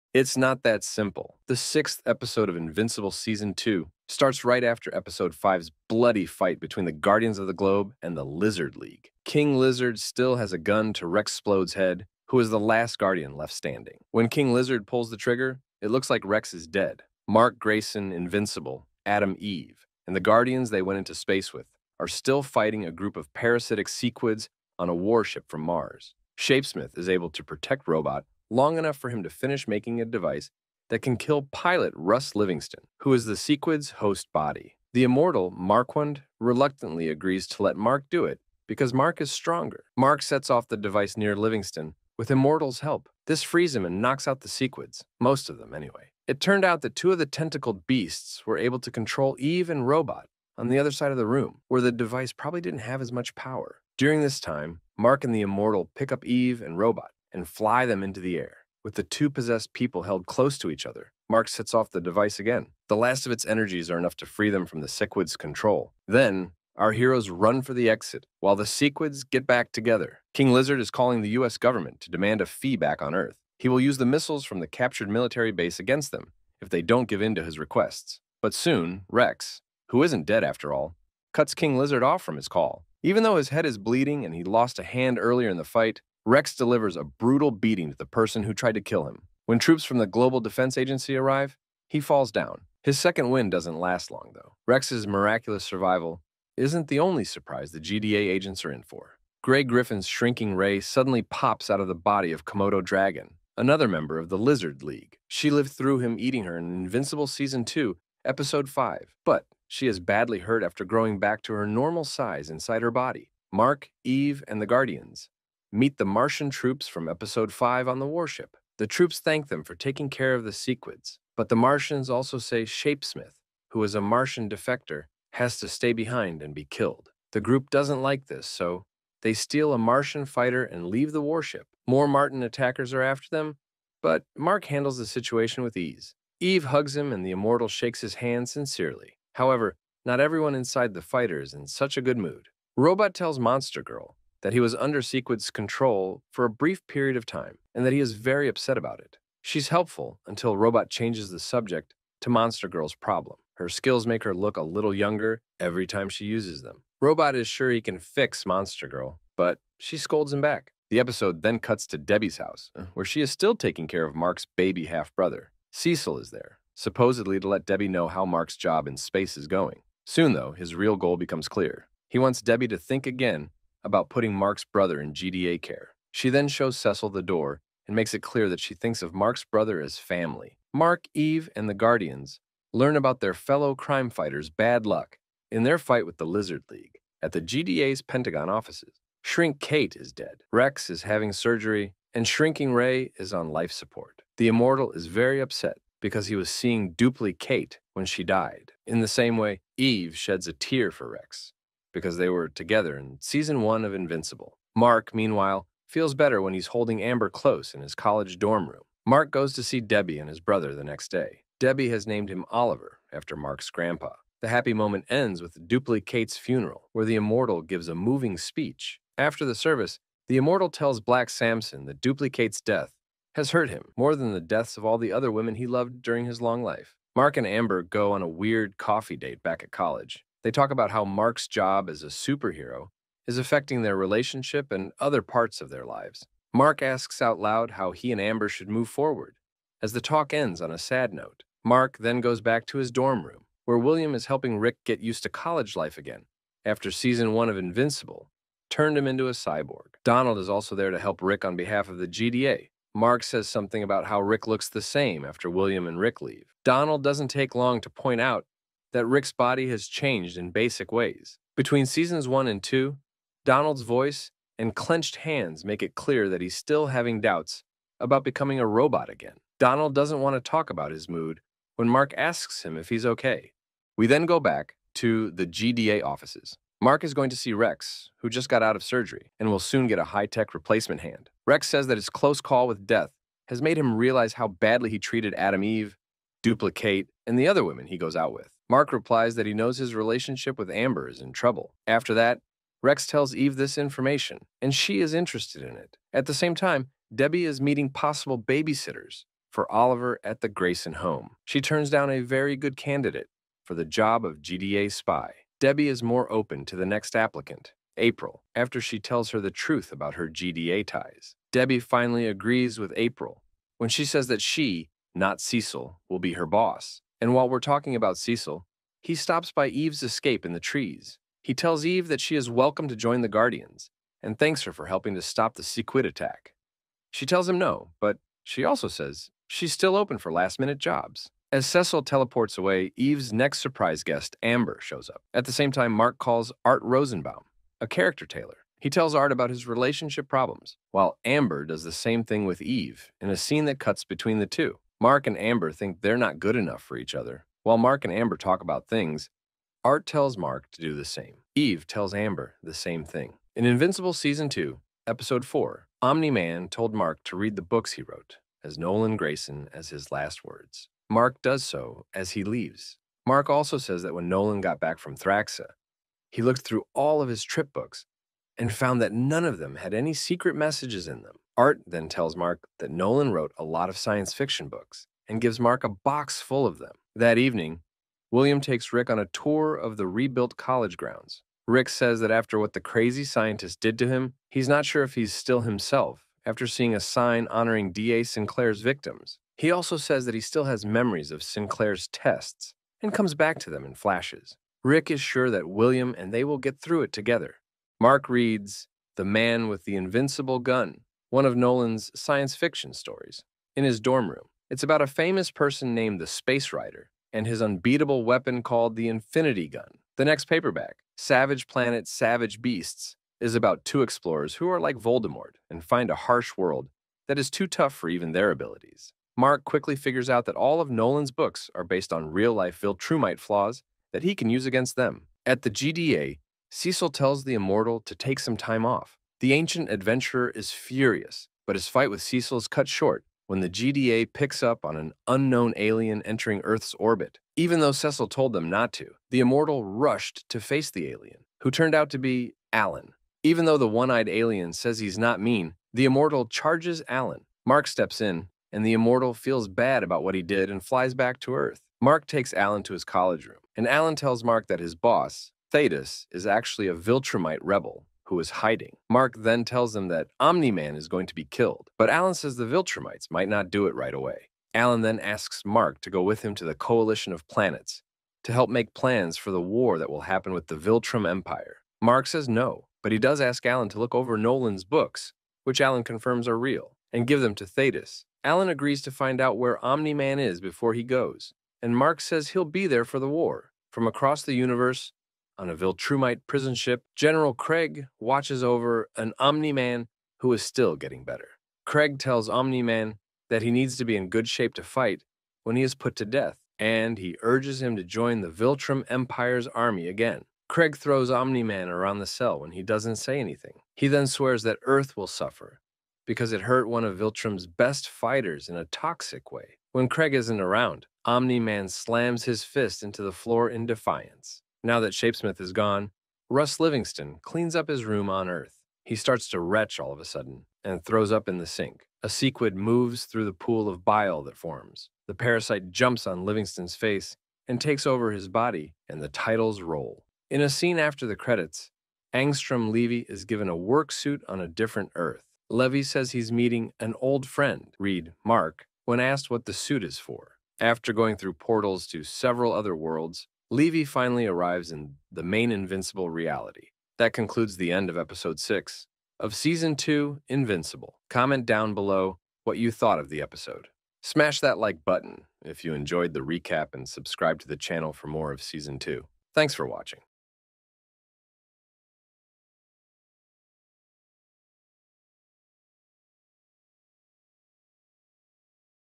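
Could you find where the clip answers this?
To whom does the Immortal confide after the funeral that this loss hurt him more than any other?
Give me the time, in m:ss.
3:41.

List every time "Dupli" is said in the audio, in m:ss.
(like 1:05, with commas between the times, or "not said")
3:16, 3:35, 3:42, 4:46.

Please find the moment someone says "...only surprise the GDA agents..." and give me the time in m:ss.
1:36.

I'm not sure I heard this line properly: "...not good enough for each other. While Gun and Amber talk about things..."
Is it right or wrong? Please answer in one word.
wrong.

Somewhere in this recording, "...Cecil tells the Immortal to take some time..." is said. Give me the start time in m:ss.
7:06.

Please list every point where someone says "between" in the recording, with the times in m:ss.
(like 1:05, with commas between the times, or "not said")
0:06, 4:21, 5:44.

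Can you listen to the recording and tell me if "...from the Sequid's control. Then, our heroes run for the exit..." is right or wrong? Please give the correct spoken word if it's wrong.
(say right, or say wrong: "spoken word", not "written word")
right.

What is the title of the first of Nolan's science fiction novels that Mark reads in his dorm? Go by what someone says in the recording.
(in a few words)
The Man with the Invincible Gun.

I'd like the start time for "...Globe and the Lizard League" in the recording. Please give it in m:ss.
0:07.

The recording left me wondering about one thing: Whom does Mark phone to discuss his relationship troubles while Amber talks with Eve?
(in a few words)
Art Rosenbaum.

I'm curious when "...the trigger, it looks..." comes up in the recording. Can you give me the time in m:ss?
0:15.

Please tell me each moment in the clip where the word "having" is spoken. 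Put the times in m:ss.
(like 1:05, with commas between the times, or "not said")
3:11, 4:26.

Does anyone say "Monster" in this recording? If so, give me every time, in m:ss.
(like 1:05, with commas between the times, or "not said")
2:23, 2:32, 2:38.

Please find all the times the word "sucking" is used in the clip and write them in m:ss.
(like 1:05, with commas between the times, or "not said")
not said.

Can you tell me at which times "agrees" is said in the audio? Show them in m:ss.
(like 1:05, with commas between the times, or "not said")
0:37, 5:12, 7:58.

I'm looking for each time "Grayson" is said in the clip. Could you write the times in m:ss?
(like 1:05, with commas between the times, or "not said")
0:17, 5:00, 5:59.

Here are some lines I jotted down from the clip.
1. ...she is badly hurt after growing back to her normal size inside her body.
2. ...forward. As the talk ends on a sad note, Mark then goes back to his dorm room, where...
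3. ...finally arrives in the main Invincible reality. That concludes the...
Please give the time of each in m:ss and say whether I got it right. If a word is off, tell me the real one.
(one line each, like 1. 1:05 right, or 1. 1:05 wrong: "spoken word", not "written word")
1. 1:49 right
2. 3:58 right
3. 9:04 right.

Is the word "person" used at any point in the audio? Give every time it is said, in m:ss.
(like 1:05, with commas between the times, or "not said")
1:28, 6:45.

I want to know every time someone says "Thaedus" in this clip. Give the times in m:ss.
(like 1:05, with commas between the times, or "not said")
7:35, 7:57.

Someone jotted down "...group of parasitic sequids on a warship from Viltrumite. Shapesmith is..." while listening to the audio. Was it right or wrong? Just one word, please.
wrong.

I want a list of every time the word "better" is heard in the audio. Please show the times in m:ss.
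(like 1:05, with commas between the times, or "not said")
3:26, 8:11.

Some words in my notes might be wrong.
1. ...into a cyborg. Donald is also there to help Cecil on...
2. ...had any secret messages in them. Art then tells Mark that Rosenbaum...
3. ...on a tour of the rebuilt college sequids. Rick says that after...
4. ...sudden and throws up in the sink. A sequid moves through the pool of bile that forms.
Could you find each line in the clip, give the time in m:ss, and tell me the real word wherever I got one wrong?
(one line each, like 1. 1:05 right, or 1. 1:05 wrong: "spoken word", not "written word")
1. 4:09 wrong: "Rick", not "Cecil"
2. 6:09 wrong: "Nolan", not "Rosenbaum"
3. 6:19 wrong: "grounds", not "sequids"
4. 8:40 right.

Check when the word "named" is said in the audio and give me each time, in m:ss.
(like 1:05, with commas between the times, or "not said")
3:32, 6:45.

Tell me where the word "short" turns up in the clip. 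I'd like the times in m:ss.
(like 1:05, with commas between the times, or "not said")
7:12.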